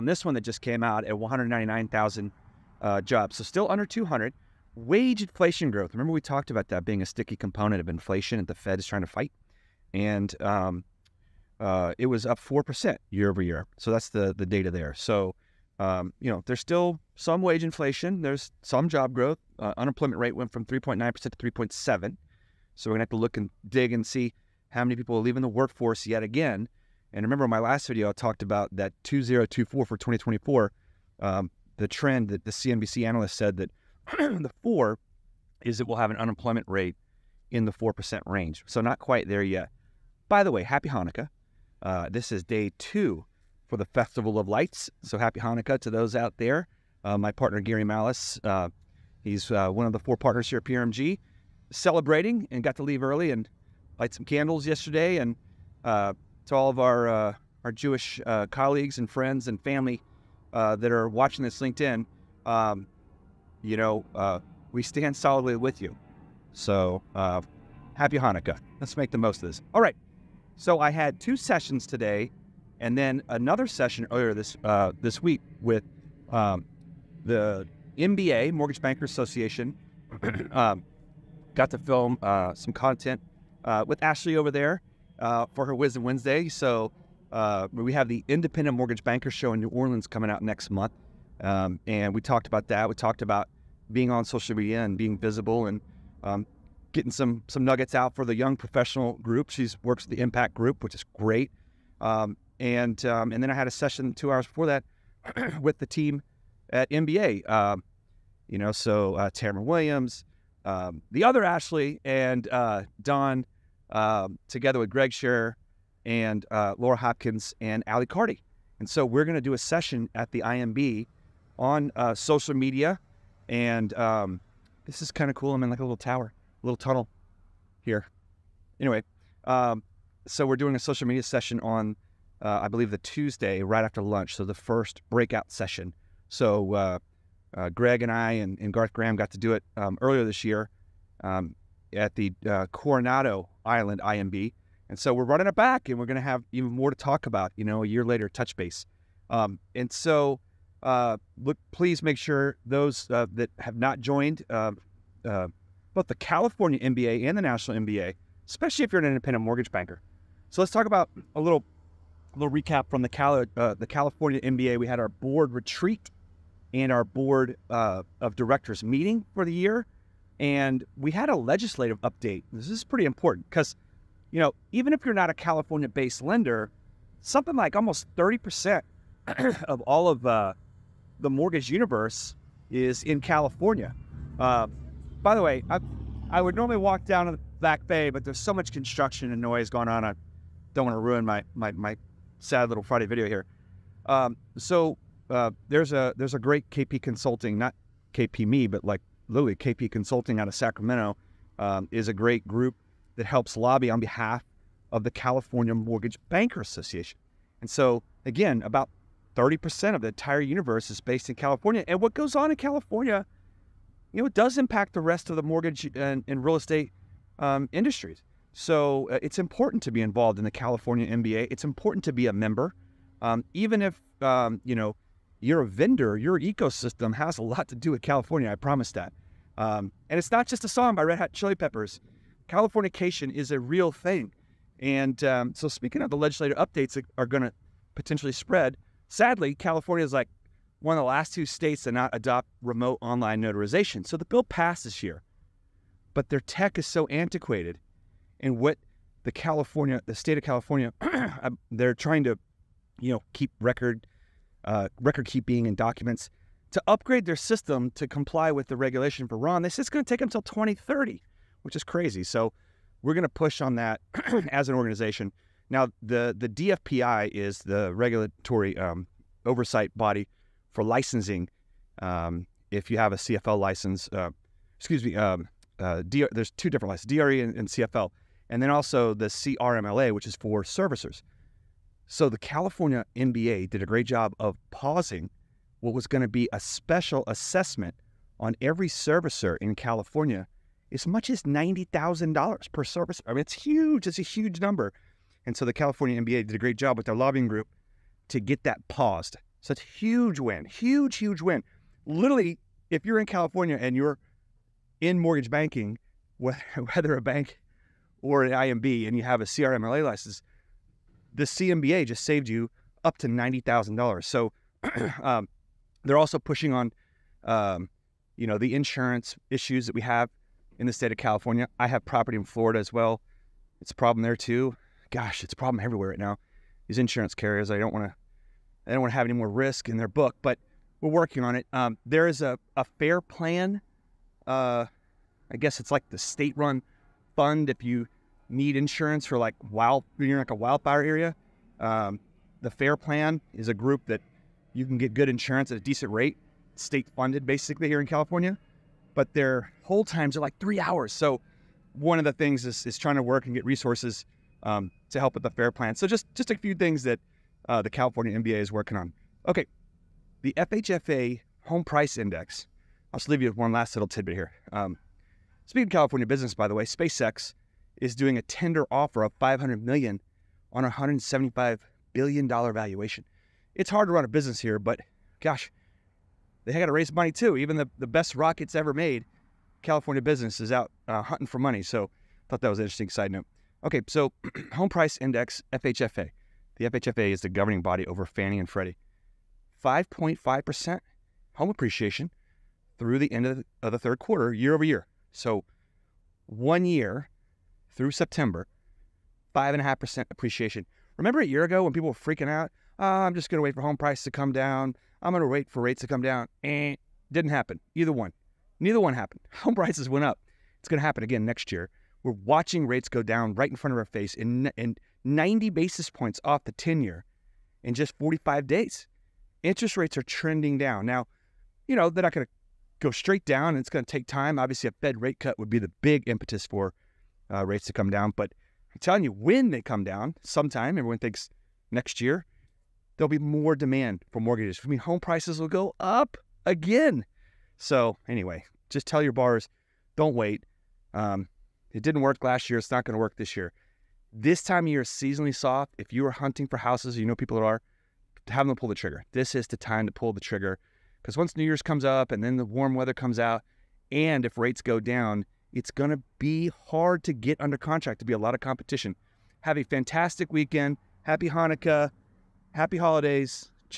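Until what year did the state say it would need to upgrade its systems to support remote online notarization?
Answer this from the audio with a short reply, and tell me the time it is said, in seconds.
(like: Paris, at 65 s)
2030, at 260 s.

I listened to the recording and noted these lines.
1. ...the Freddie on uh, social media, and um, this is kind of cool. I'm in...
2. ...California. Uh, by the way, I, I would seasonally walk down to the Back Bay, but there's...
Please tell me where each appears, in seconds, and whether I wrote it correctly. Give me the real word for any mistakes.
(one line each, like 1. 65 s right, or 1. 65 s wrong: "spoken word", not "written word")
1. 120 s wrong: "IMB", not "Freddie"
2. 183 s wrong: "normally", not "seasonally".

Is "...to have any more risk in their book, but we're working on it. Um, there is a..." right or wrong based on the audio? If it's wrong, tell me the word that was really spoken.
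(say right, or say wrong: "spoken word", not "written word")
right.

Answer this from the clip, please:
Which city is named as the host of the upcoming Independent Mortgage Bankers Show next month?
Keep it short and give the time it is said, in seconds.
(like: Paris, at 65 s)
New Orleans, at 89 s.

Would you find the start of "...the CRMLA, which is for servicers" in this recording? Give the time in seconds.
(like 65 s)
279 s.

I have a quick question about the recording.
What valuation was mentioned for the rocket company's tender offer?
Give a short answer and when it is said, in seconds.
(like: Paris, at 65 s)
$175 billion, at 370 s.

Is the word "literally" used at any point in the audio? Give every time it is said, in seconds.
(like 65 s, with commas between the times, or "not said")
199 s, 302 s.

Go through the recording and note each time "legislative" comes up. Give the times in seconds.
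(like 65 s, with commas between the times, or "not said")
171 s, 236 s.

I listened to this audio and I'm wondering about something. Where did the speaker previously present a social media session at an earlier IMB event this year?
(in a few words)
Coronado Island.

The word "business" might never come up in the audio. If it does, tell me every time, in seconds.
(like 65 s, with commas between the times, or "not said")
366 s, 374 s, 380 s.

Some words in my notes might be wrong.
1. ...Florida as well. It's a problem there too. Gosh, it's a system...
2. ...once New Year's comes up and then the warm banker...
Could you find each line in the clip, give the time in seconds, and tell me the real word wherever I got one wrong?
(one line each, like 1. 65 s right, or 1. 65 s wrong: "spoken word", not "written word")
1. 322 s wrong: "problem", not "system"
2. 451 s wrong: "weather", not "banker".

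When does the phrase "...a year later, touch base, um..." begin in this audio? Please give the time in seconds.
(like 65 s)
147 s.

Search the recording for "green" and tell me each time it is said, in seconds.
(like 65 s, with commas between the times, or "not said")
not said.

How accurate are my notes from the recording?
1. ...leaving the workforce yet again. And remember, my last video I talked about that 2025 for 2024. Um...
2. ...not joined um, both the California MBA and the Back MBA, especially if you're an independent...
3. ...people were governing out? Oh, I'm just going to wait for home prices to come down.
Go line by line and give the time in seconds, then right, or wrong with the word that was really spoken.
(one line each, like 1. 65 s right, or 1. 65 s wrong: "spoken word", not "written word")
1. 25 s wrong: "2024", not "2025"
2. 153 s wrong: "National", not "Back"
3. 401 s wrong: "freaking", not "governing".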